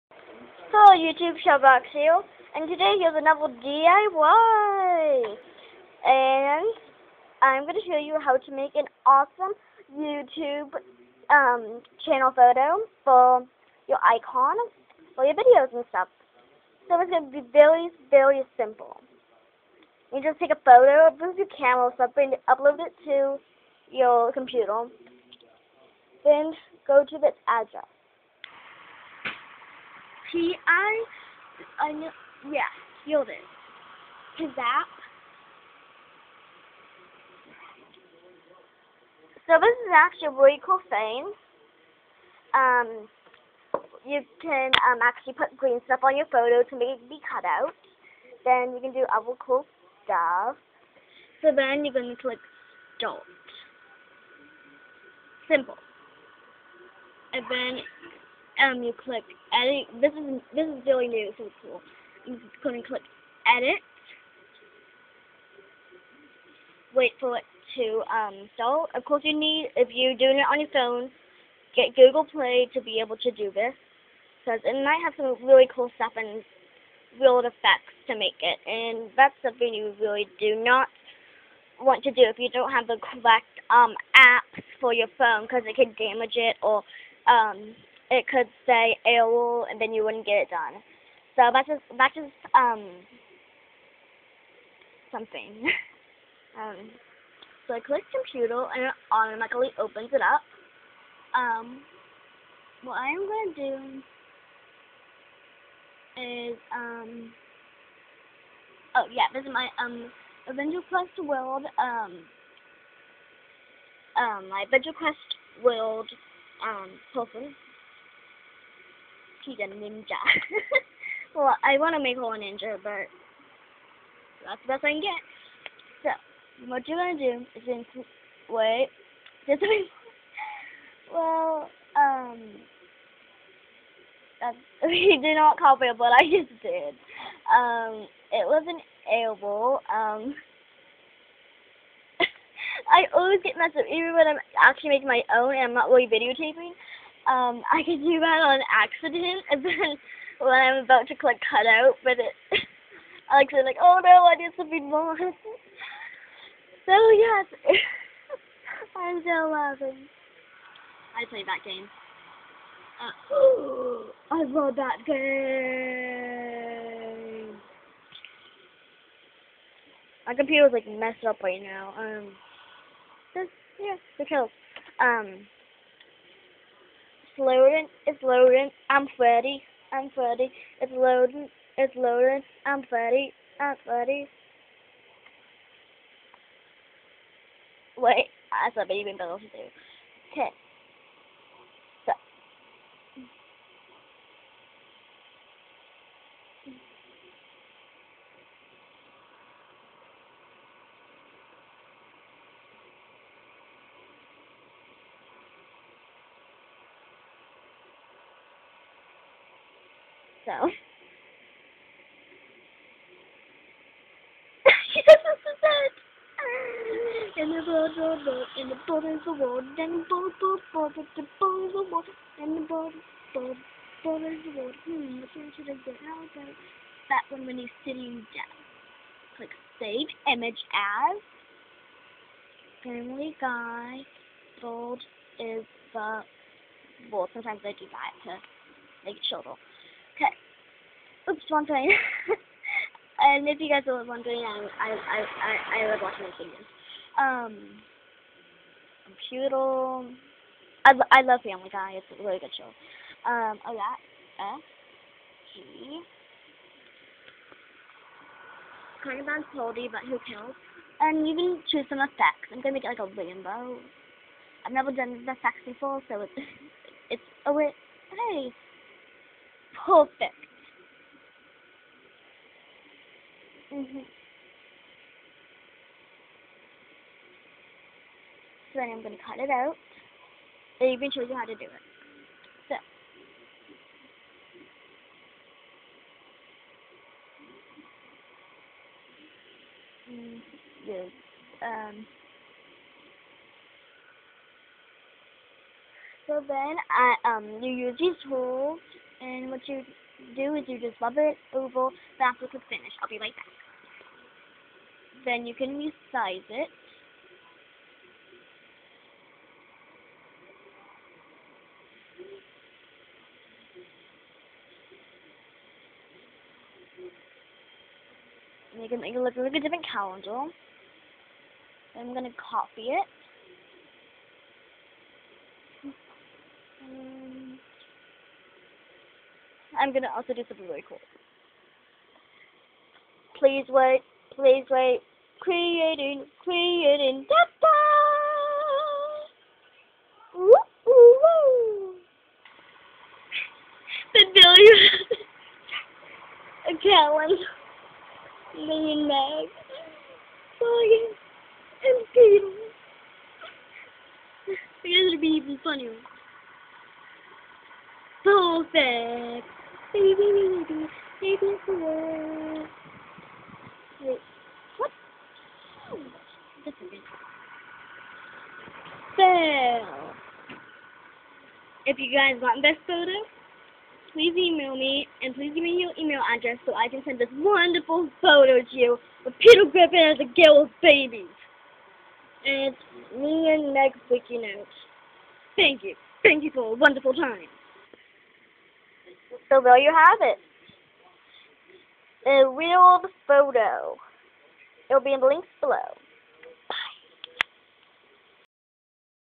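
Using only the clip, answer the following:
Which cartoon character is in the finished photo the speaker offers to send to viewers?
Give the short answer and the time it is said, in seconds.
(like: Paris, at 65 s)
Peter Griffin, at 379 s.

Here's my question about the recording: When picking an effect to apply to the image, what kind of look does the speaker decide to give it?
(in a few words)
Rainbow.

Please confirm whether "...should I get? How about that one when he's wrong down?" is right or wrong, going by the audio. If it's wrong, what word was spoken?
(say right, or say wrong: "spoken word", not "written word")
wrong: "sitting", not "wrong".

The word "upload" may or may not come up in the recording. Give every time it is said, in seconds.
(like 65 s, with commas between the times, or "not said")
22 s.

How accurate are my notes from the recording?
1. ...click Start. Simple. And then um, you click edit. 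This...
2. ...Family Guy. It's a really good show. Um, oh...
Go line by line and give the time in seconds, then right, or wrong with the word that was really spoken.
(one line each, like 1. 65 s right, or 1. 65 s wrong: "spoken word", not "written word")
1. 52 s right
2. 251 s right.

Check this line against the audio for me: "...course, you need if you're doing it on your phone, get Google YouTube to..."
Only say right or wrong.
wrong.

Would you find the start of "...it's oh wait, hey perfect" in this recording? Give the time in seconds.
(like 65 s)
267 s.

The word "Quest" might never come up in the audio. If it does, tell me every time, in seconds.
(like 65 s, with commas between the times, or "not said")
110 s, 114 s.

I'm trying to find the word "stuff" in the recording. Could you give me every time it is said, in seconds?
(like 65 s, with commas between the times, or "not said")
15 s, 45 s, 50 s, 75 s.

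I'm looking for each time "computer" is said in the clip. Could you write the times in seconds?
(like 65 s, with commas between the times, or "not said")
24 s, 98 s, 170 s, 249 s.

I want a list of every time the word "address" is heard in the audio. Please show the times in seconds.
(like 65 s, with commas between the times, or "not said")
27 s, 376 s.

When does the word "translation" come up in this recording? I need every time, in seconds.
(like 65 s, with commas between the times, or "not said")
not said.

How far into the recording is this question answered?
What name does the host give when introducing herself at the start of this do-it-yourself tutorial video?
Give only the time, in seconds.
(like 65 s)
1 s.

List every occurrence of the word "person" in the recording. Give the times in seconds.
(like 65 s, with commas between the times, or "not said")
117 s.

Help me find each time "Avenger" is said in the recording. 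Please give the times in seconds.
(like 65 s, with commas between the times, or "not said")
110 s, 114 s.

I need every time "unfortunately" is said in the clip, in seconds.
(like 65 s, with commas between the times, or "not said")
not said.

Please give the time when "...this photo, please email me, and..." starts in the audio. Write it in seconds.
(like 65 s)
372 s.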